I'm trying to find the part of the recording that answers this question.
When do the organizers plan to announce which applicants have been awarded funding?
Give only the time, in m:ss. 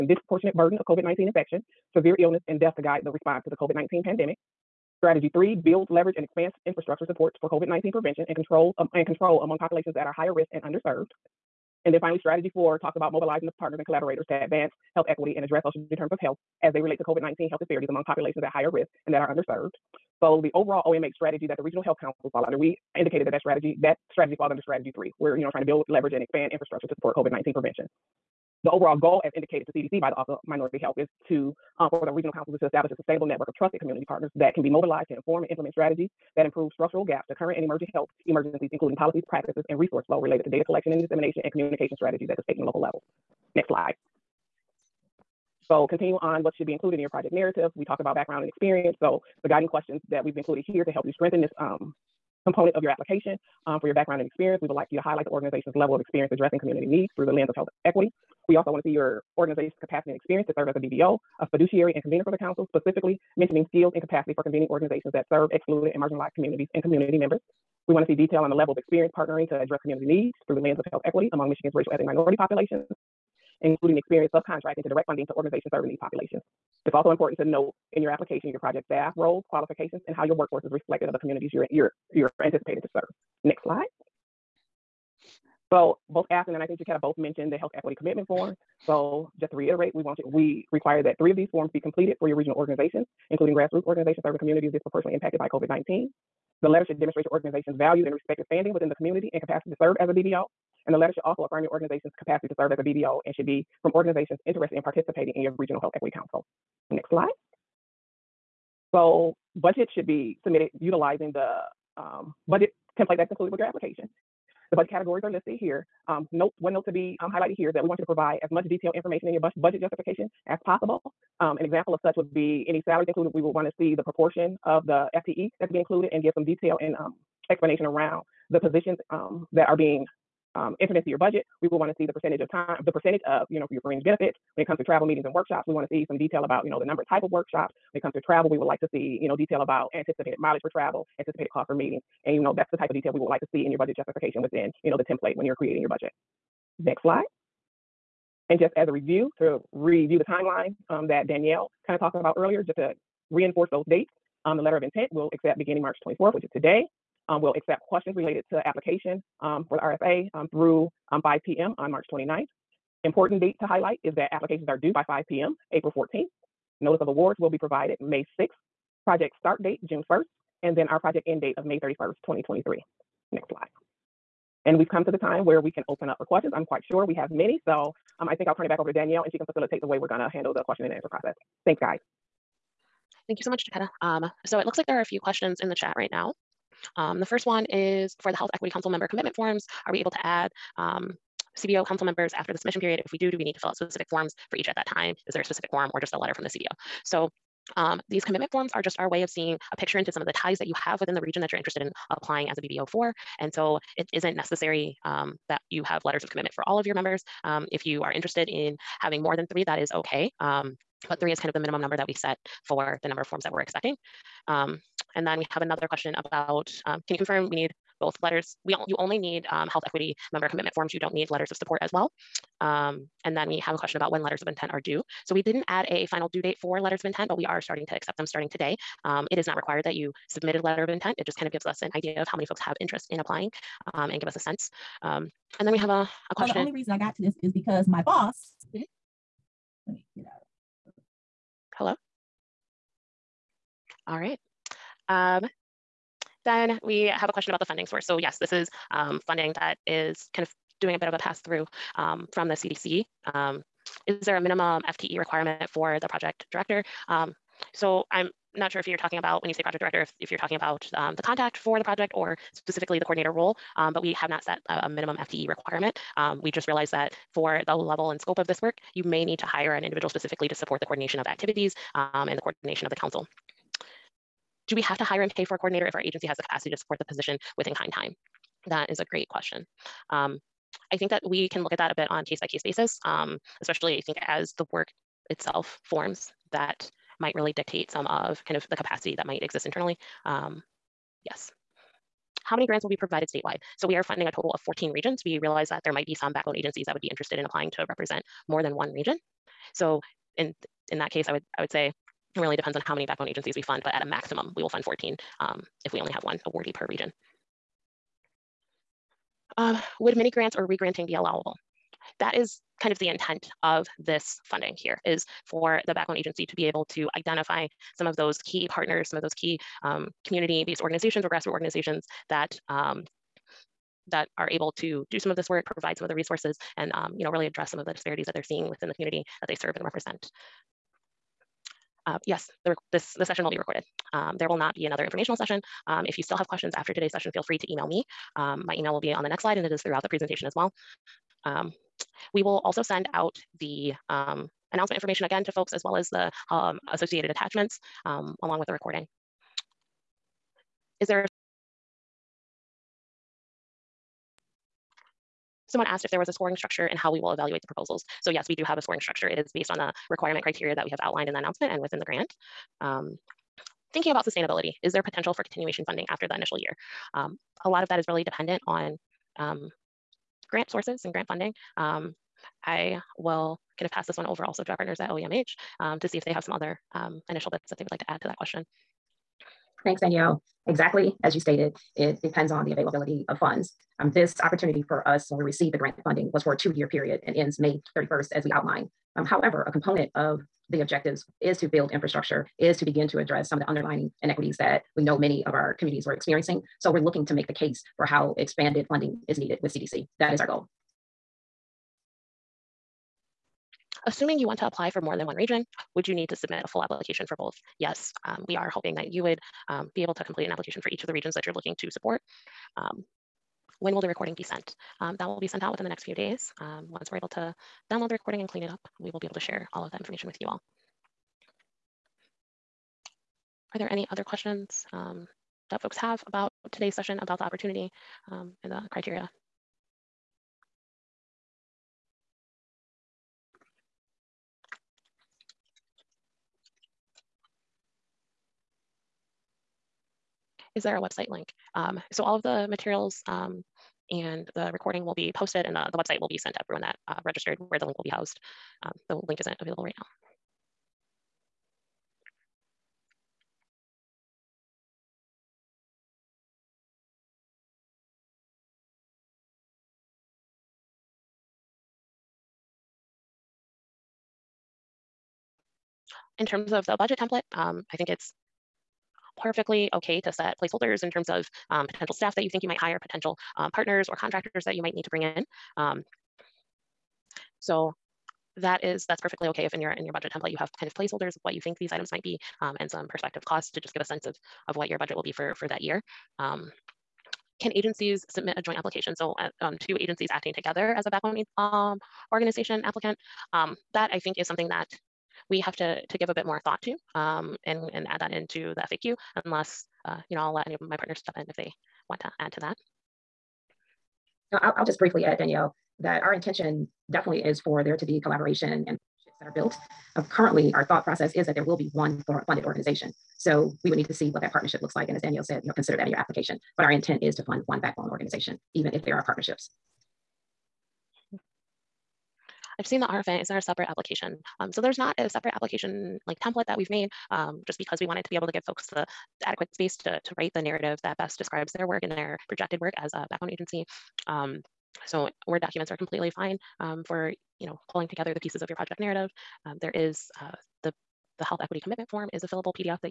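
2:48.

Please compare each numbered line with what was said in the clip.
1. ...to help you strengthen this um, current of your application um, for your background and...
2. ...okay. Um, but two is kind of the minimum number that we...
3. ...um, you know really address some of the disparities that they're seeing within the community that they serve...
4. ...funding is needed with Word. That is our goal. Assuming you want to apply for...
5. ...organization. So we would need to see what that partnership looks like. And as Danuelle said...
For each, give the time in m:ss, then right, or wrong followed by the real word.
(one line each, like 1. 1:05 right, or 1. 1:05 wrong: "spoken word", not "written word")
1. 0:50 wrong: "component", not "current"
2. 3:29 wrong: "three", not "two"
3. 5:26 right
4. 6:38 wrong: "CDC", not "Word"
5. 8:32 right.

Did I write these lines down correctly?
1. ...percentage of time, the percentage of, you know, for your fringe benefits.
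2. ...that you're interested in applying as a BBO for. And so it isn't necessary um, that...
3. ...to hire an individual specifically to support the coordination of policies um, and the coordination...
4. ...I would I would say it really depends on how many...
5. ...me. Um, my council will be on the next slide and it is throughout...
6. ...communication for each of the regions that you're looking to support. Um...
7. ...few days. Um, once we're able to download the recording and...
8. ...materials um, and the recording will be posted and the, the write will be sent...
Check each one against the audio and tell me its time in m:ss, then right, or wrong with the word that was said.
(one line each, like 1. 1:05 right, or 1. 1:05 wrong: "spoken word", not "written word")
1. 2:12 right
2. 3:21 right
3. 4:29 wrong: "activities", not "policies"
4. 5:01 right
5. 5:37 wrong: "email", not "council"
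6. 6:50 wrong: "application", not "communication"
7. 6:56 right
8. 7:22 wrong: "website", not "write".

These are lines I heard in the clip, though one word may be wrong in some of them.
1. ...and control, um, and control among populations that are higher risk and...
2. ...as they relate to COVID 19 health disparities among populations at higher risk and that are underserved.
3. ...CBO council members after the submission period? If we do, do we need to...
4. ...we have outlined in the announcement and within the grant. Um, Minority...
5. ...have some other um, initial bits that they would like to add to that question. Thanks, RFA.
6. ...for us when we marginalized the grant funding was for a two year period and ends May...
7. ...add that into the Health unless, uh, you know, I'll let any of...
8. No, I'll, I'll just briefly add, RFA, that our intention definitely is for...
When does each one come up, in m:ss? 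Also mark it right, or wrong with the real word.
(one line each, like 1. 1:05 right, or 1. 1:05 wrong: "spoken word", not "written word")
1. 0:08 right
2. 0:16 right
3. 3:11 right
4. 6:00 wrong: "Thinking", not "Minority"
5. 6:16 wrong: "Danuelle", not "RFA"
6. 6:24 wrong: "received", not "marginalized"
7. 8:18 wrong: "FAQ", not "Health"
8. 8:24 wrong: "Danuelle", not "RFA".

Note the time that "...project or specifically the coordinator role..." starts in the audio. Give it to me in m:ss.
4:21.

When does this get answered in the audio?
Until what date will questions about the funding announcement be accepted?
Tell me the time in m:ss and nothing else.
2:41.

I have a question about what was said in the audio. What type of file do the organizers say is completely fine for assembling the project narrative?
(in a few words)
Word documents.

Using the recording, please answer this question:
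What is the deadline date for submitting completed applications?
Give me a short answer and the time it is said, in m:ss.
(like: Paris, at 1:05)
April 14th, at 2:45.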